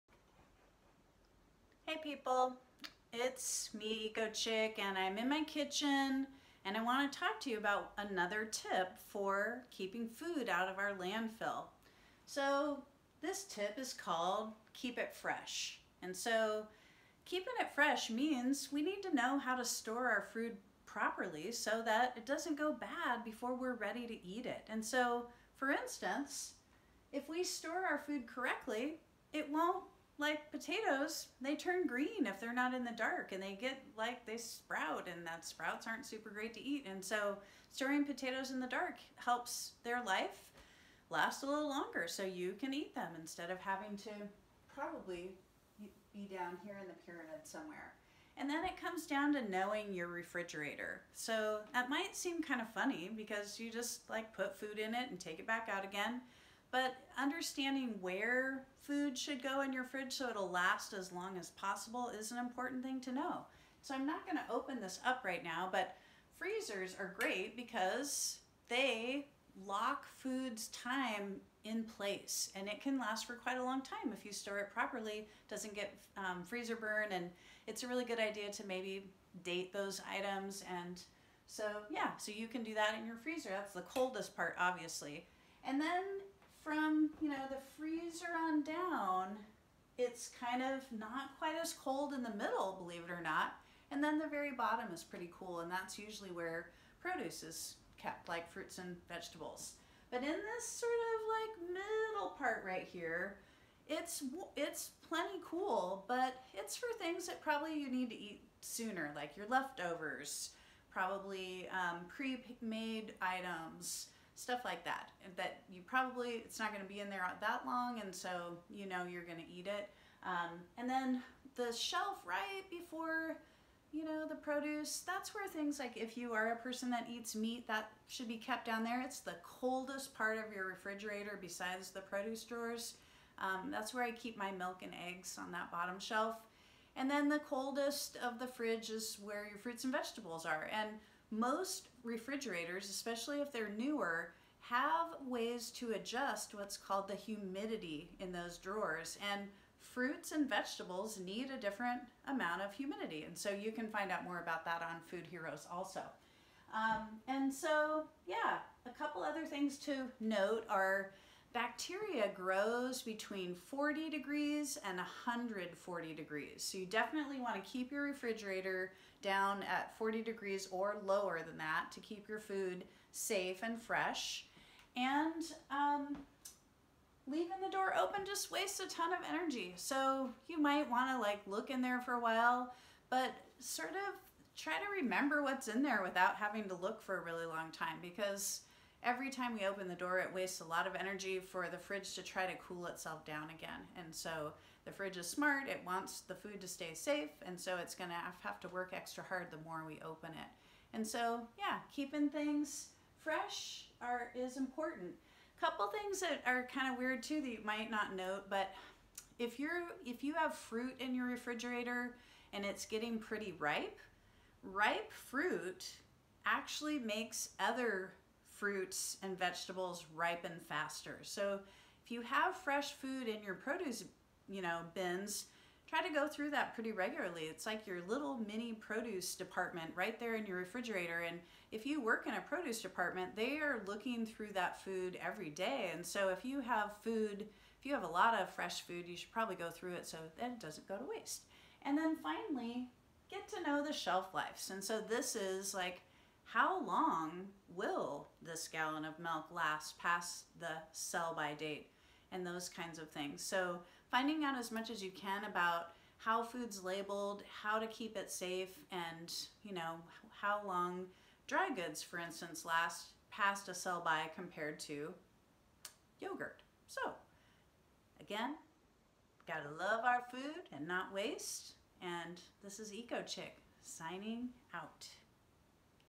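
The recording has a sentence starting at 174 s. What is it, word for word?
And um, leaving the door open just wastes a ton of energy.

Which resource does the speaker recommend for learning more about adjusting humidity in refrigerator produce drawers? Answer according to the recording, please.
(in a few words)
Food Heroes.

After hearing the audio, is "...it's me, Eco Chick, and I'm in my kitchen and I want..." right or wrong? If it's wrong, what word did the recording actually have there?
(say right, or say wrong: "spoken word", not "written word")
right.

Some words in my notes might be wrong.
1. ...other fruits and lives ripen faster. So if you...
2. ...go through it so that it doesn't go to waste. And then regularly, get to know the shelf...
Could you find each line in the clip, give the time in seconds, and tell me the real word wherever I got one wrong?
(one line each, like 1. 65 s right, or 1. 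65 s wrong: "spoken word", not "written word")
1. 217 s wrong: "vegetables", not "lives"
2. 239 s wrong: "finally", not "regularly".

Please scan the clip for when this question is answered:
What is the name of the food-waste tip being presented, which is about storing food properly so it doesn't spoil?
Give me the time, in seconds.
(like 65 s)
14 s.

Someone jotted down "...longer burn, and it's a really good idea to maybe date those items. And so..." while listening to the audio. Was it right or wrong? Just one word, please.
wrong.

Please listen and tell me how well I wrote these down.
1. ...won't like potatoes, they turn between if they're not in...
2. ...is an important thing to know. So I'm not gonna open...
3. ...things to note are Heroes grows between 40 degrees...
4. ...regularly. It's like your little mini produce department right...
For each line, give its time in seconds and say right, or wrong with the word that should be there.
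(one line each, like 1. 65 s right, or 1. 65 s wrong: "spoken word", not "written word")
1. 29 s wrong: "green", not "between"
2. 62 s right
3. 159 s wrong: "Bacteria", not "Heroes"
4. 226 s right.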